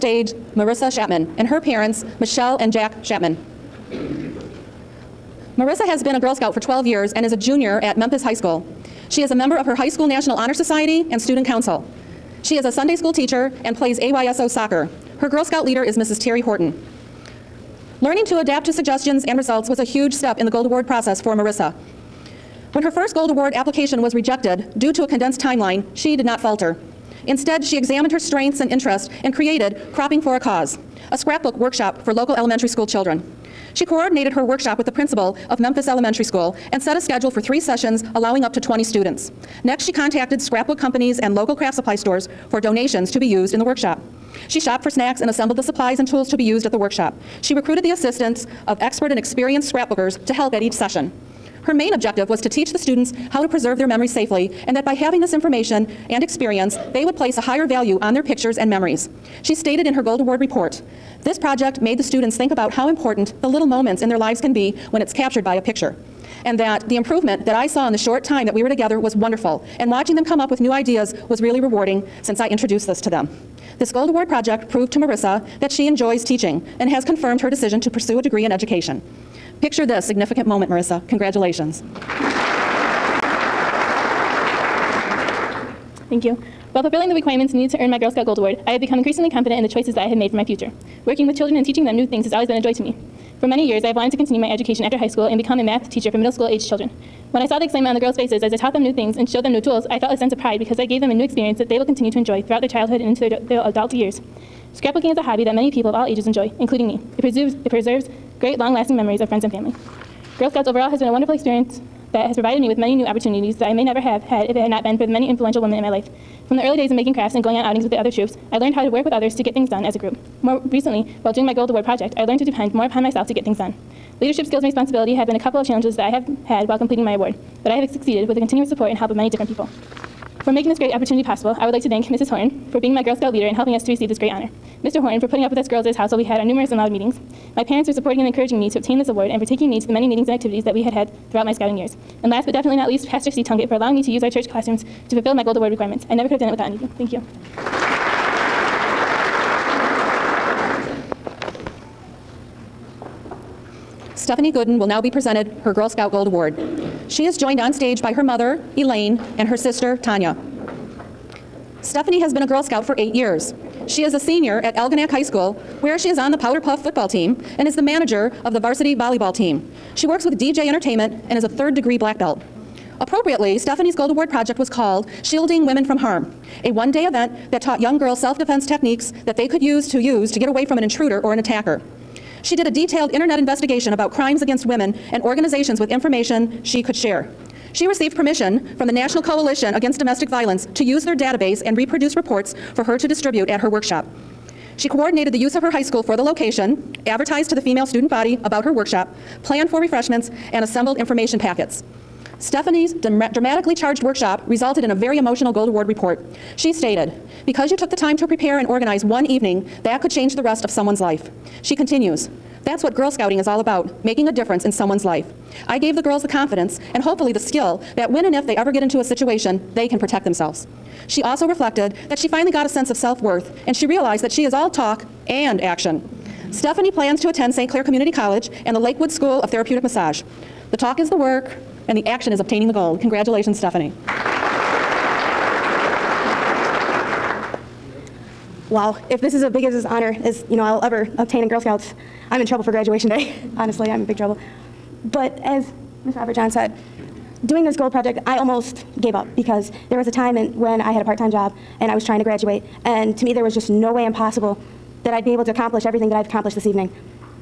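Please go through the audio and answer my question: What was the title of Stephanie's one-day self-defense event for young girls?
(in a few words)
Shielding Women from Harm.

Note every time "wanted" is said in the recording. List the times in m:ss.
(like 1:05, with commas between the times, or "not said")
1:33.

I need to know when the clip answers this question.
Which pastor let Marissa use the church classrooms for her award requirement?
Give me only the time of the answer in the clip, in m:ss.
2:23.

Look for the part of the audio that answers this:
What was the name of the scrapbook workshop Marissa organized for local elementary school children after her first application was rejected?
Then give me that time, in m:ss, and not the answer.
0:29.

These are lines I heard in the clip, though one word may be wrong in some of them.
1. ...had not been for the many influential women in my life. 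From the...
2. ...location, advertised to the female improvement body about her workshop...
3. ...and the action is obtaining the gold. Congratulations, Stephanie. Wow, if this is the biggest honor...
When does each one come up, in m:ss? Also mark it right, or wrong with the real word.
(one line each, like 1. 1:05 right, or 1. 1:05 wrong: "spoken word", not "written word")
1. 1:54 right
2. 3:16 wrong: "student", not "improvement"
3. 3:51 right.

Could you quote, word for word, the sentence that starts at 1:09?
And watching them come up with new ideas was really rewarding since I introduced this to them.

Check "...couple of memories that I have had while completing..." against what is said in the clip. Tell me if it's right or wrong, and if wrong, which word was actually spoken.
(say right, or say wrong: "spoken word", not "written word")
wrong: "challenges", not "memories".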